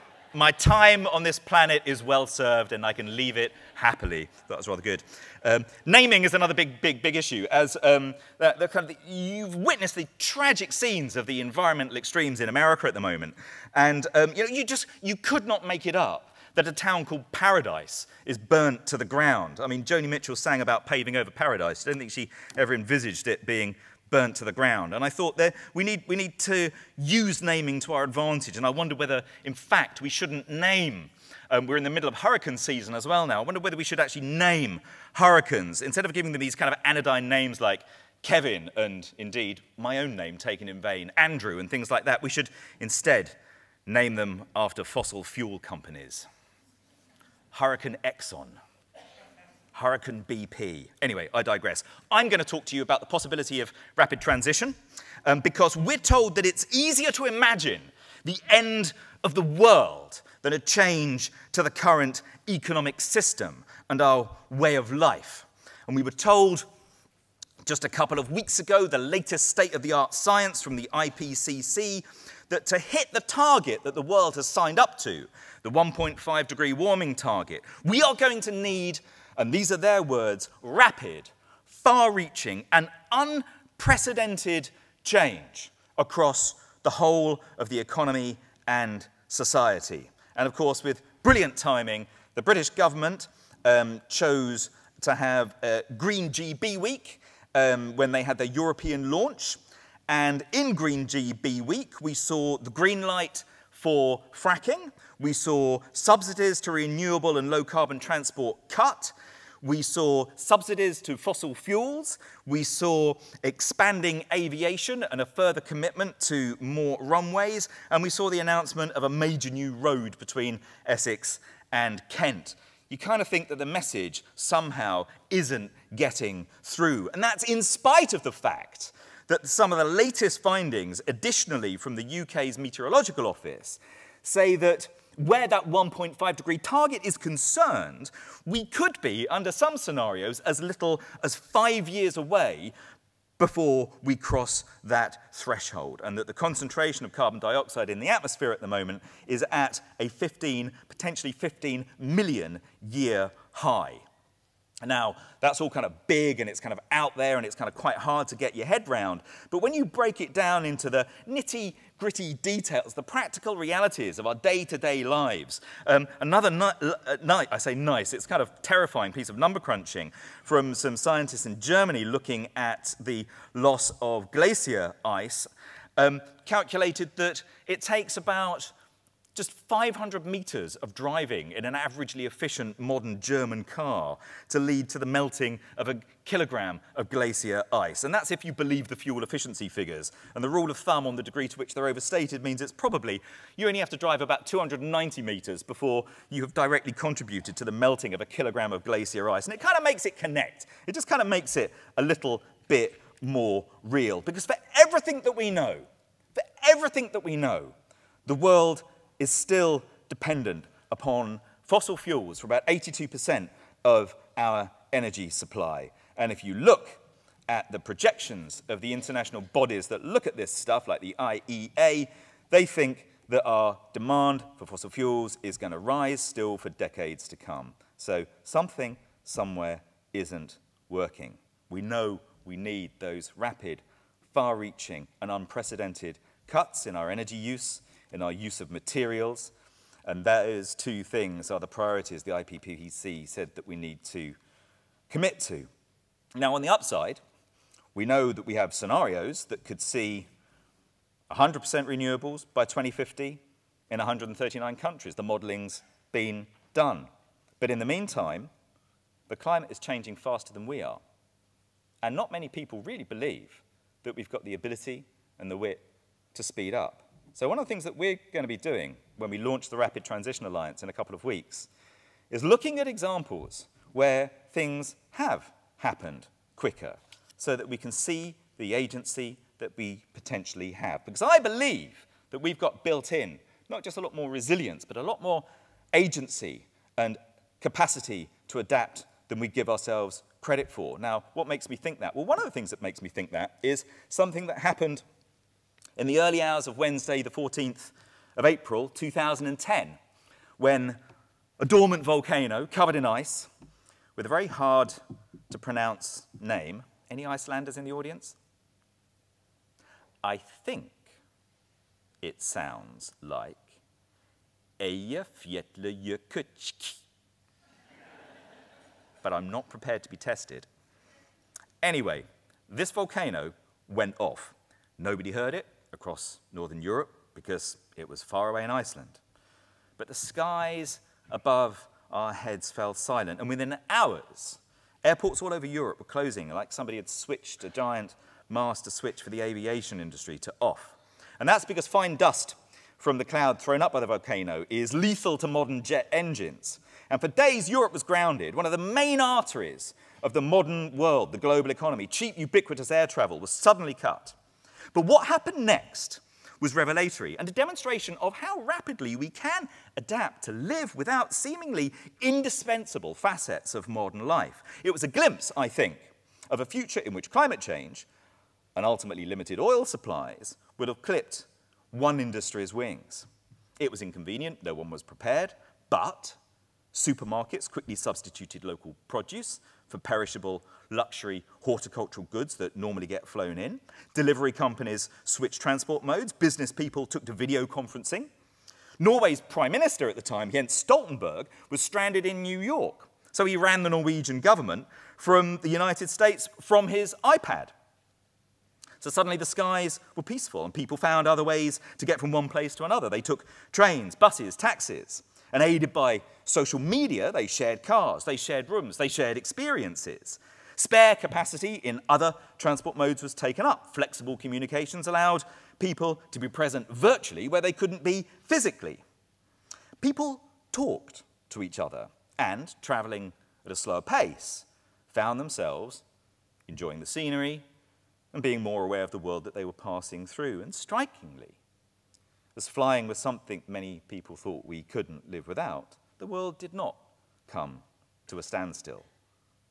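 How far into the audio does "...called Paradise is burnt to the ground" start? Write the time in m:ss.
0:17.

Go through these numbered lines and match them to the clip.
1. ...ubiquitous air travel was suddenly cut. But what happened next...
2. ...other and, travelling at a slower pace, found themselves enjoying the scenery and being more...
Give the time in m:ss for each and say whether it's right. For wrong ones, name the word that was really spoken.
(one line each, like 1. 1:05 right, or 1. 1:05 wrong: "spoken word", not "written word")
1. 5:52 right
2. 7:01 right.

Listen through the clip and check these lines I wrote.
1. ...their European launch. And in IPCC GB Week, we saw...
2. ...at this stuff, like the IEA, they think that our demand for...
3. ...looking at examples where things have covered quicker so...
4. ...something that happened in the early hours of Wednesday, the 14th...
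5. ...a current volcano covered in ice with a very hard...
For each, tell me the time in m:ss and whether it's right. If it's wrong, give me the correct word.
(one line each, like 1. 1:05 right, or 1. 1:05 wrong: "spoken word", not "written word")
1. 1:38 wrong: "Green", not "IPCC"
2. 3:40 right
3. 4:32 wrong: "happened", not "covered"
4. 4:54 right
5. 5:01 wrong: "dormant", not "current".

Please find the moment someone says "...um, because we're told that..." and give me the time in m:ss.
0:55.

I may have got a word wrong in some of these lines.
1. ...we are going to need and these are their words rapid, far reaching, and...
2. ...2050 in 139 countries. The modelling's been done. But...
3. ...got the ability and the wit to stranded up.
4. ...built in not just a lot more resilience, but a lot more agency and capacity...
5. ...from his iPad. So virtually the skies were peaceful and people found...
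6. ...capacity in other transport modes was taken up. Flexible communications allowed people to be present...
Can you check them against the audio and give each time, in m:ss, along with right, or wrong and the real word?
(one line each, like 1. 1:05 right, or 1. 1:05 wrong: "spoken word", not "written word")
1. 1:17 right
2. 4:12 right
3. 4:24 wrong: "speed", not "stranded"
4. 4:42 right
5. 6:36 wrong: "suddenly", not "virtually"
6. 6:51 right.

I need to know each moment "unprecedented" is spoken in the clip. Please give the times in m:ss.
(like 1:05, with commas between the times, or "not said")
1:23, 3:55.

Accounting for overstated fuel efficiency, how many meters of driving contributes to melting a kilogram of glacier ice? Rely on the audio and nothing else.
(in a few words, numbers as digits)
290 meters.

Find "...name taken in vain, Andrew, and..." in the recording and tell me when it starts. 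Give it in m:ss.
0:40.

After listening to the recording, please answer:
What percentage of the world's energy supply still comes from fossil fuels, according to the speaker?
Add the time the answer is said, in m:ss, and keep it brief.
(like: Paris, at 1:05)
82%, at 3:32.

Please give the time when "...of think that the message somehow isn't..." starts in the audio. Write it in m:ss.
2:03.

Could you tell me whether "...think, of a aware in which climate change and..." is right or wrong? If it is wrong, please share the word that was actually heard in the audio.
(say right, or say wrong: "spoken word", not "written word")
wrong: "future", not "aware".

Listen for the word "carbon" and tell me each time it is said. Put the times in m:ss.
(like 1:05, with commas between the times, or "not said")
1:47, 2:27.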